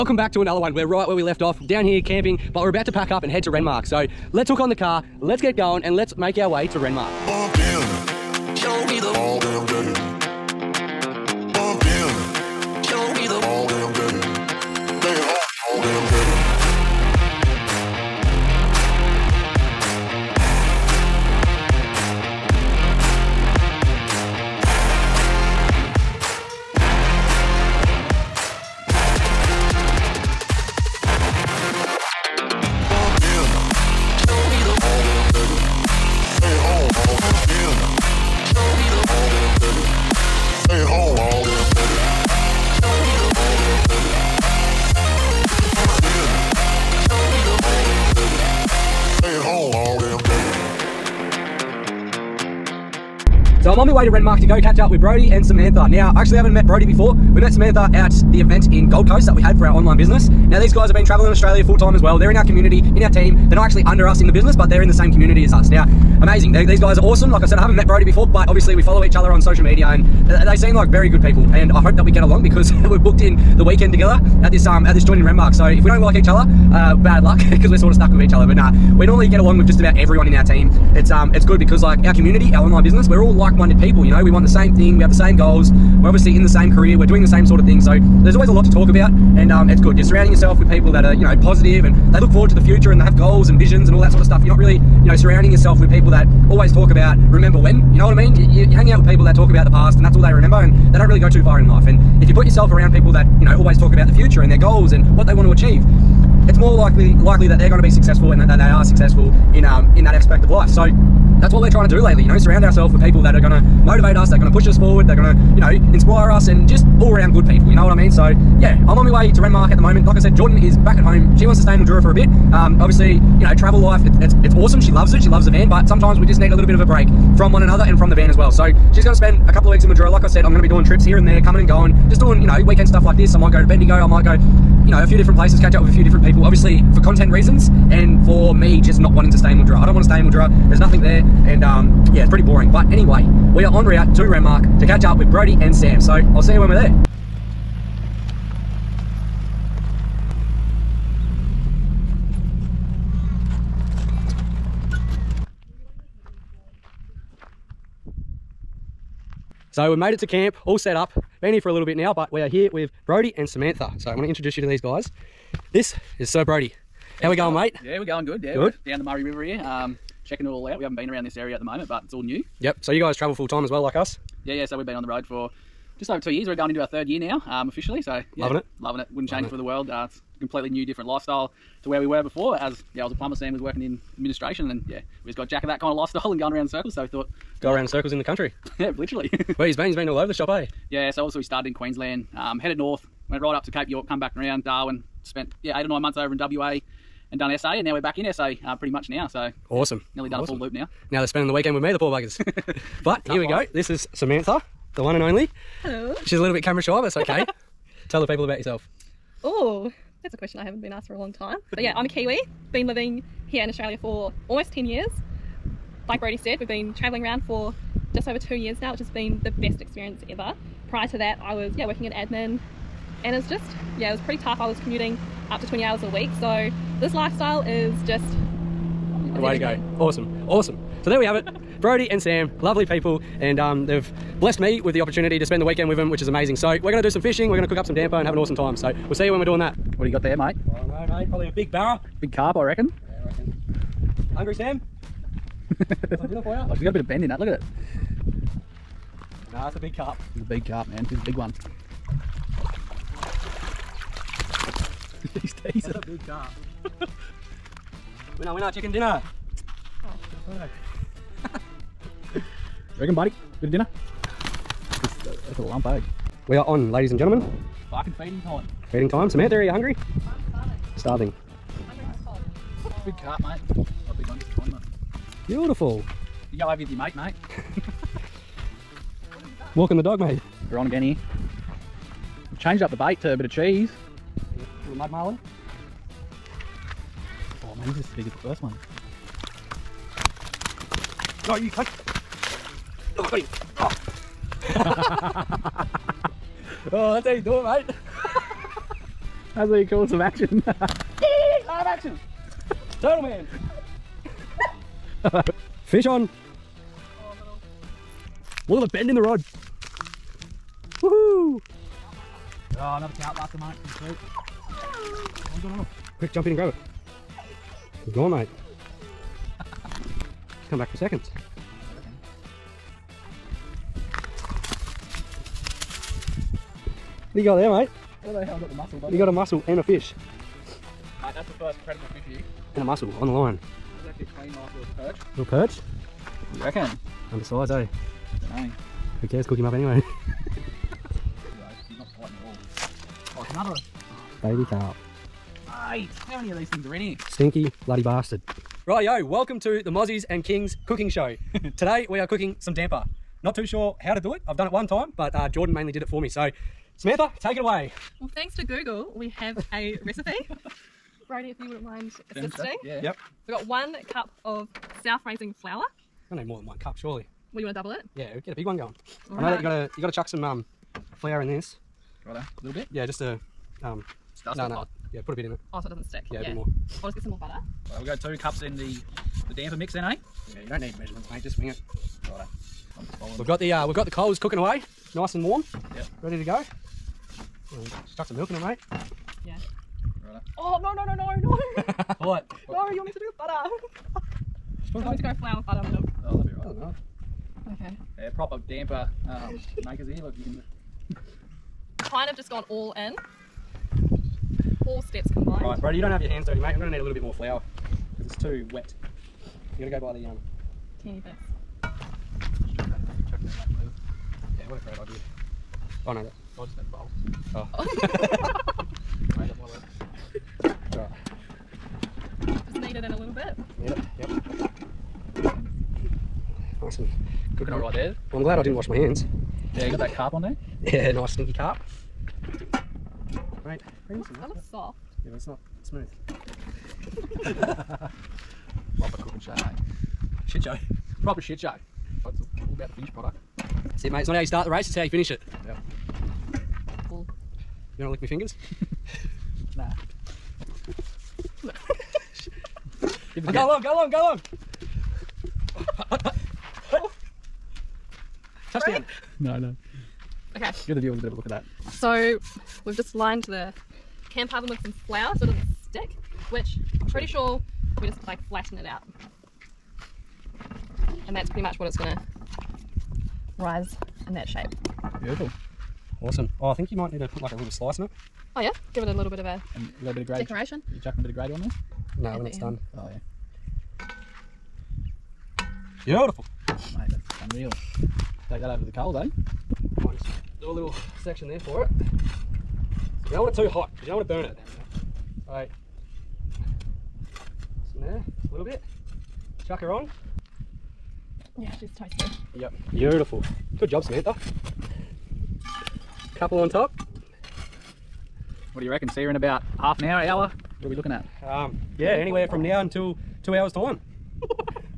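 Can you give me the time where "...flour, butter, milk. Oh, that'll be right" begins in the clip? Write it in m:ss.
6:35.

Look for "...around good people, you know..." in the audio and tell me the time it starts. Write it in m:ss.
1:57.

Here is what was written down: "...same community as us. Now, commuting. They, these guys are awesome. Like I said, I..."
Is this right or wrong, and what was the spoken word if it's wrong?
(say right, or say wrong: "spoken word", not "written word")
wrong: "amazing", not "commuting".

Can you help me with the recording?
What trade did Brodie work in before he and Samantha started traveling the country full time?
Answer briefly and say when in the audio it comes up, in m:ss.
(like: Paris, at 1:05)
Plumber, at 3:03.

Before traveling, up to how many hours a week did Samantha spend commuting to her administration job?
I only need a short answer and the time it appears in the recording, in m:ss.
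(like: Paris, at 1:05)
20 hours, at 3:45.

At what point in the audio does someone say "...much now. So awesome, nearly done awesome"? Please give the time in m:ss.
3:18.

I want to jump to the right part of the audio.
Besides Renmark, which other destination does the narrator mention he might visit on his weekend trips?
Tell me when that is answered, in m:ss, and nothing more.
2:13.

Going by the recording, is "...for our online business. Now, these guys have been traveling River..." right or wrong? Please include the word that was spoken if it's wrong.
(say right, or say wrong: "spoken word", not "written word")
wrong: "Australia", not "River".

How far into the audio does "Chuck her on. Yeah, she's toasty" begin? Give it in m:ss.
8:19.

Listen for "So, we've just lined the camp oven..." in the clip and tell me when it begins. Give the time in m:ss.
7:41.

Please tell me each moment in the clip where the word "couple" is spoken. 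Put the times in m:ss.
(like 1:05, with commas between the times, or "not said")
2:09, 8:26.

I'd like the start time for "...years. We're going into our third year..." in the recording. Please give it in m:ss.
2:56.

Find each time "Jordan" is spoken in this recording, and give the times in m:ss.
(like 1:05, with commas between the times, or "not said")
2:00, 5:55.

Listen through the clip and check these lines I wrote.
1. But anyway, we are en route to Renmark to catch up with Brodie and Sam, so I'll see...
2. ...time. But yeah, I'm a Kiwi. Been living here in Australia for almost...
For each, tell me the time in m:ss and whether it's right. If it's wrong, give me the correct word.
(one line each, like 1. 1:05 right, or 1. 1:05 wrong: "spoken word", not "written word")
1. 2:22 right
2. 3:31 right.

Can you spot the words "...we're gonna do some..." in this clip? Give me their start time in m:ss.
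3:56.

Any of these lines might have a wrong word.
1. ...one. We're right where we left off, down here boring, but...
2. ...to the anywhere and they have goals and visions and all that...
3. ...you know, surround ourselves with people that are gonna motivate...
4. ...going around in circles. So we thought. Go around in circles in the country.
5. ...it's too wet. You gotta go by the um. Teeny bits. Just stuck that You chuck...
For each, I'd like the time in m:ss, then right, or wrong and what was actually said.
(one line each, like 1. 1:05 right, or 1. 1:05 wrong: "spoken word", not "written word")
1. 0:00 wrong: "camping", not "boring"
2. 1:32 wrong: "future", not "anywhere"
3. 1:52 right
4. 3:06 right
5. 6:48 wrong: "chuck", not "stuck".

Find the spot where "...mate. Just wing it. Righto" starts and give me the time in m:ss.
6:21.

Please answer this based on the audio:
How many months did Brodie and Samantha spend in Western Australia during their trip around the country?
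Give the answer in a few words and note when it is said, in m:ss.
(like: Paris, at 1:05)
8 or 9 months, at 3:15.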